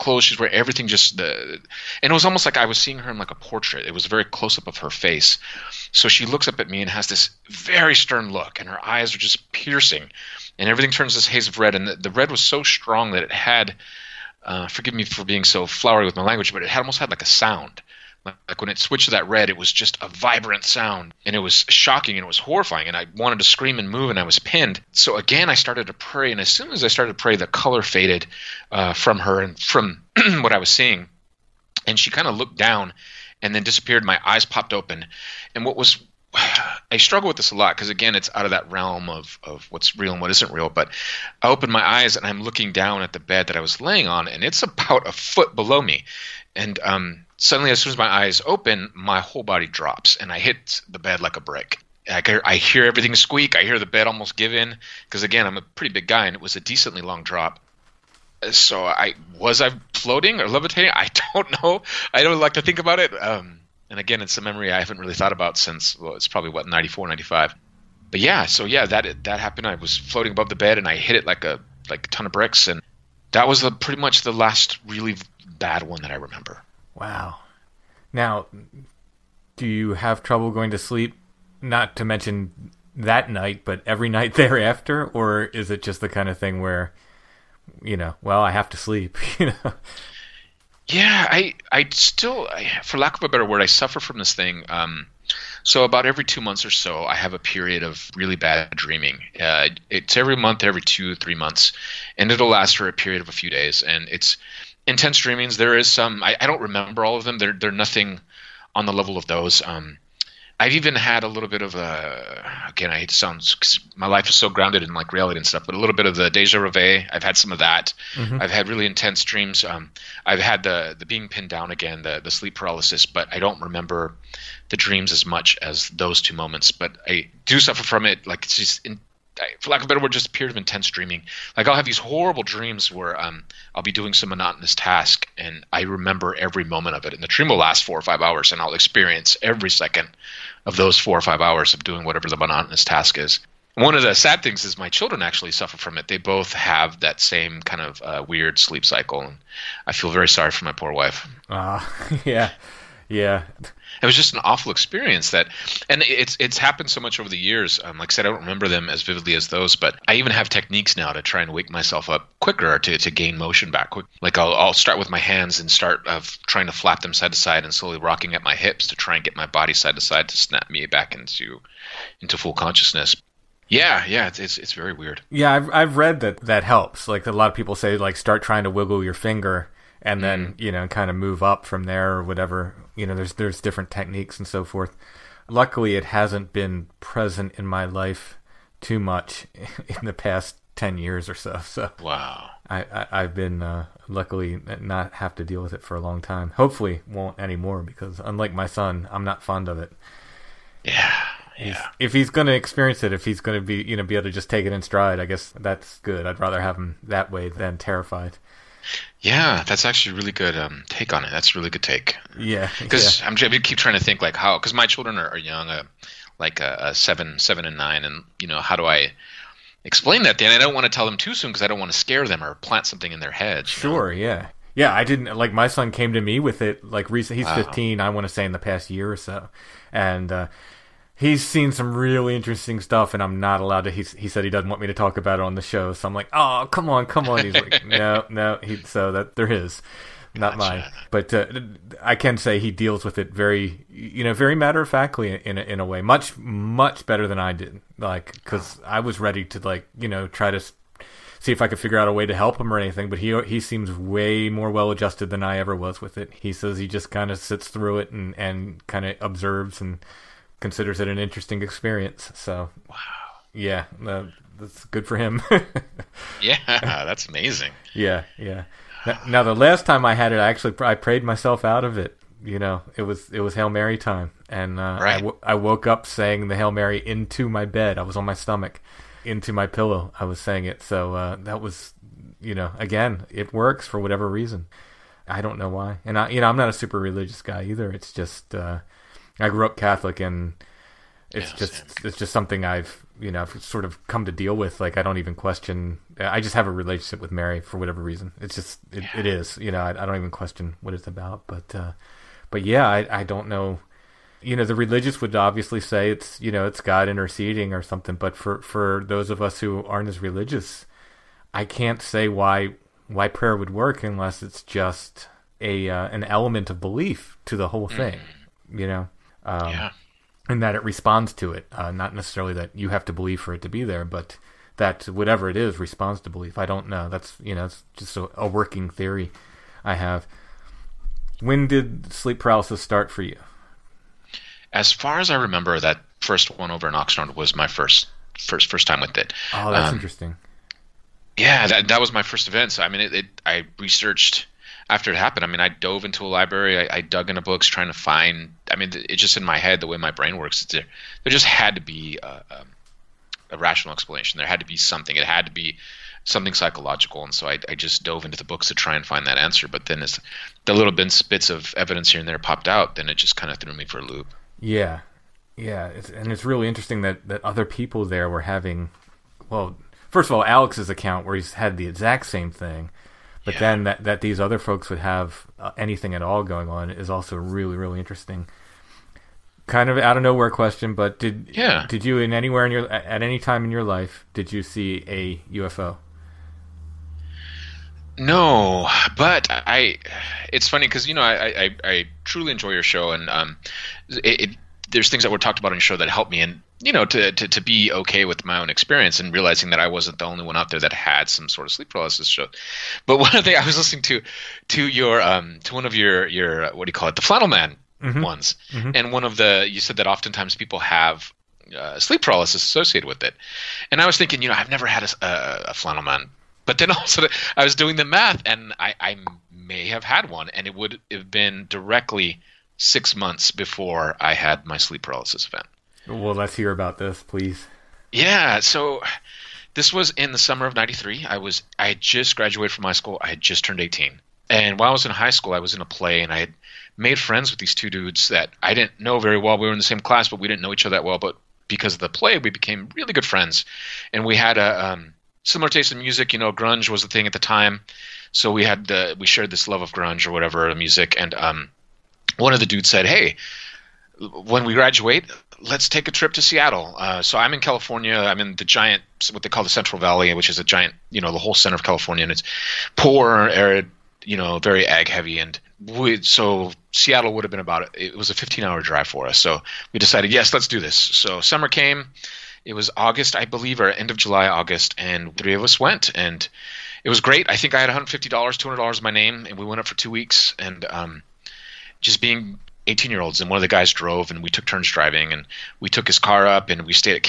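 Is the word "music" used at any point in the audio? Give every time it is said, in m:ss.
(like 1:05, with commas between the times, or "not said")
7:25, 7:30.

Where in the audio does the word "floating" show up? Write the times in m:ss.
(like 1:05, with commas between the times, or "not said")
0:59, 1:09.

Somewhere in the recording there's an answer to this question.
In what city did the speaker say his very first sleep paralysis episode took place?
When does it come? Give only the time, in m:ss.
5:36.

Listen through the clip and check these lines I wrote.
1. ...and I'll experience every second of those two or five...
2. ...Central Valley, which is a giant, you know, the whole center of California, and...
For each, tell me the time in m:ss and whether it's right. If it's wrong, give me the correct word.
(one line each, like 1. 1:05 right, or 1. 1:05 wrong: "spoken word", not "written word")
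1. 2:18 wrong: "four", not "two"
2. 7:39 right.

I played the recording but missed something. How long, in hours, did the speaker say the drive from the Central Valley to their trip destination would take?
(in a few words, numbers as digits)
15 hours.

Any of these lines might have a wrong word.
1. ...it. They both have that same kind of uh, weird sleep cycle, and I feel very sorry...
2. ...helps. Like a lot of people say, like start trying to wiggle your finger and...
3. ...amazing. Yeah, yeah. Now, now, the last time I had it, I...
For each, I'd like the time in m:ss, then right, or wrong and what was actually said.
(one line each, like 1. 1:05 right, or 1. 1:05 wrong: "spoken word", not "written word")
1. 2:25 right
2. 2:56 right
3. 4:27 right.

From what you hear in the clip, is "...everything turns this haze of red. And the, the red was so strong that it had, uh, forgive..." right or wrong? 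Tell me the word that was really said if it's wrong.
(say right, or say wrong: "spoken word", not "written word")
right.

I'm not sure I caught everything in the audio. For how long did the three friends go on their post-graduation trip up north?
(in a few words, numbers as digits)
two weeks.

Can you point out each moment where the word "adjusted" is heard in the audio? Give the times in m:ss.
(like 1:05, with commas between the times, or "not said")
4:14.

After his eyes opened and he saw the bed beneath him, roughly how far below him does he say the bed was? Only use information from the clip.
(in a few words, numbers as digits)
a foot.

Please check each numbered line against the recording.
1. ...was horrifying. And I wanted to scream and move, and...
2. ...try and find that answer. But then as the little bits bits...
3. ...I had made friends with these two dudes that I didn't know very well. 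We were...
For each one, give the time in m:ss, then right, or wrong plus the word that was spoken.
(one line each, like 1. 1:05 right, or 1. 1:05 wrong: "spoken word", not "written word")
1. 0:22 right
2. 5:58 right
3. 7:16 right.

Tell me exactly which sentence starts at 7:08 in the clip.
Yeah, so this was in the summer of 93.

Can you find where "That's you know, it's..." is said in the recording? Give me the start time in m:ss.
5:27.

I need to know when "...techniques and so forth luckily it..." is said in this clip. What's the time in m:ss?
3:03.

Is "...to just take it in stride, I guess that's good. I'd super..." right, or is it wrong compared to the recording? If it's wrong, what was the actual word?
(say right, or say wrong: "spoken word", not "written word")
wrong: "rather", not "super".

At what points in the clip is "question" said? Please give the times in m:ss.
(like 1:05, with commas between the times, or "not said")
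4:55, 5:00, 6:20.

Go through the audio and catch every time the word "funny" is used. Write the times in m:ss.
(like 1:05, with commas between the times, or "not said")
6:30.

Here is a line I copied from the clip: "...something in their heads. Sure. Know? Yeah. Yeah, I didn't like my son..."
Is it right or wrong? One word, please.
right.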